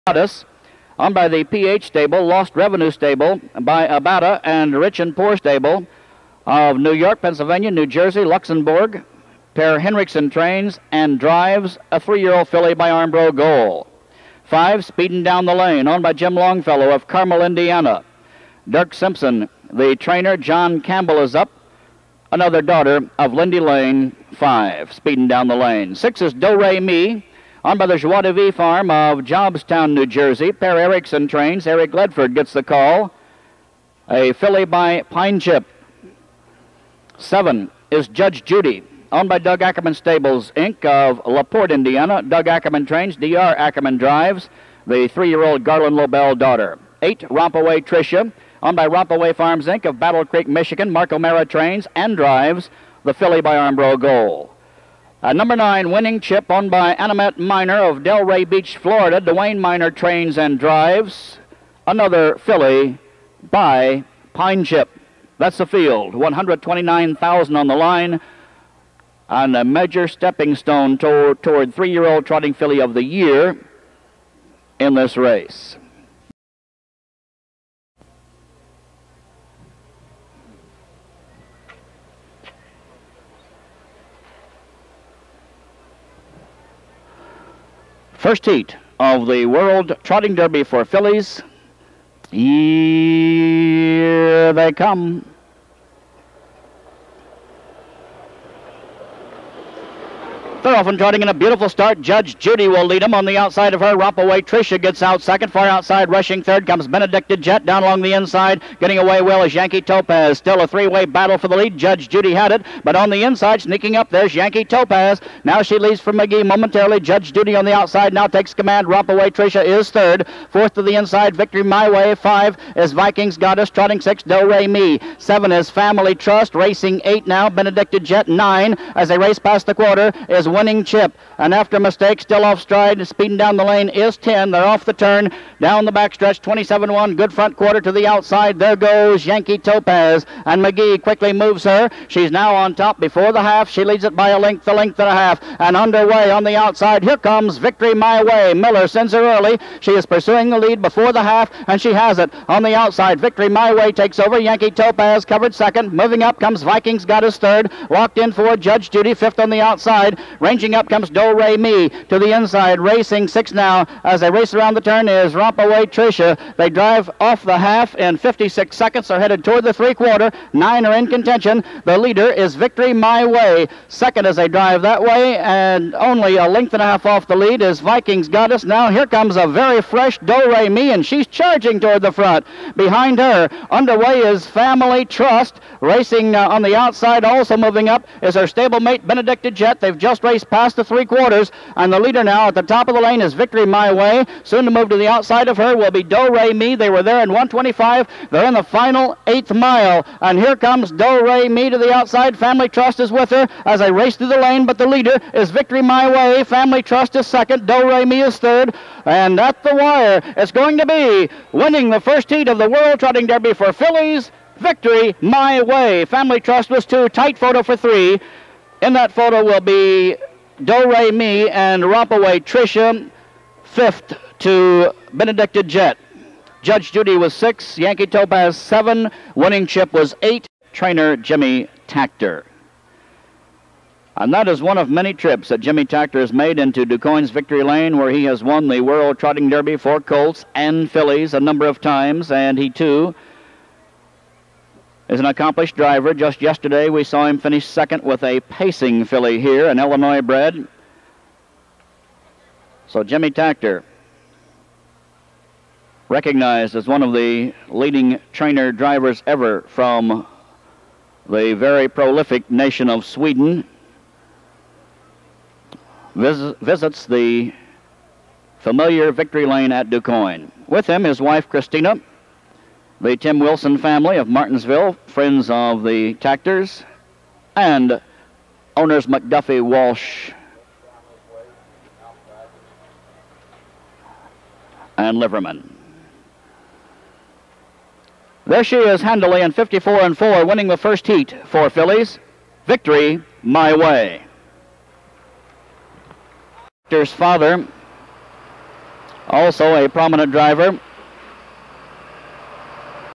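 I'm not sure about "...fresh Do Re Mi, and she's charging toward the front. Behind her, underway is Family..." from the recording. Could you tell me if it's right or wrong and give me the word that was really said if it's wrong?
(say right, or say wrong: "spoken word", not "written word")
right.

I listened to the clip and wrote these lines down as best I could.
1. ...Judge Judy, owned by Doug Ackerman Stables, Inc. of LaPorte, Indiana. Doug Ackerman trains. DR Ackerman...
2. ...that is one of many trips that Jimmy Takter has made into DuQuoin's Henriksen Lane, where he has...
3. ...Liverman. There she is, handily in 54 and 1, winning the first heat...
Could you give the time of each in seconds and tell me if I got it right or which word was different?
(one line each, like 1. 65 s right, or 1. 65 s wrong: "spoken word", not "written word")
1. 38 s right
2. 234 s wrong: "Victory", not "Henriksen"
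3. 285 s wrong: "4", not "1".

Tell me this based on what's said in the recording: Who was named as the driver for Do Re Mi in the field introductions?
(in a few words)
Eric Ledford.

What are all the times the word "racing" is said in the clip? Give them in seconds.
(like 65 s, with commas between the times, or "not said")
126 s, 162 s, 185 s.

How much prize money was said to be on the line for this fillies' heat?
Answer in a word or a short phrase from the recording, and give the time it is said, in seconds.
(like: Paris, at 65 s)
$129,000, at 66 s.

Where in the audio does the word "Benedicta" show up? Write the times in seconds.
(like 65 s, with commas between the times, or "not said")
106 s, 127 s, 189 s, 225 s.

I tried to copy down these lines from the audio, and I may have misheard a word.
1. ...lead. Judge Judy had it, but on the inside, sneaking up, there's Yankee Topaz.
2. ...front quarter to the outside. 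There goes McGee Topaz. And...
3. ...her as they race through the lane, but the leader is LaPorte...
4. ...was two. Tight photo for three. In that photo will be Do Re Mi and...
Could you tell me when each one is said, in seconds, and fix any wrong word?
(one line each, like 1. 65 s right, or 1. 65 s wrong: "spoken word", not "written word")
1. 111 s right
2. 137 s wrong: "Yankee", not "McGee"
3. 203 s wrong: "Victory", not "LaPorte"
4. 216 s right.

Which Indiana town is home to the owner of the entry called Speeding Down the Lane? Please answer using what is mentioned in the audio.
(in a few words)
Carmel.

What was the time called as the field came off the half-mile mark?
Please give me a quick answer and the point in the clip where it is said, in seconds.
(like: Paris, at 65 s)
56 seconds, at 168 s.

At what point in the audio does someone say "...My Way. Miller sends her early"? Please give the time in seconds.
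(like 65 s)
147 s.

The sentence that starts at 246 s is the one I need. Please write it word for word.
Just yesterday, we saw him finish second with a pacing filly here, an Illinois bred.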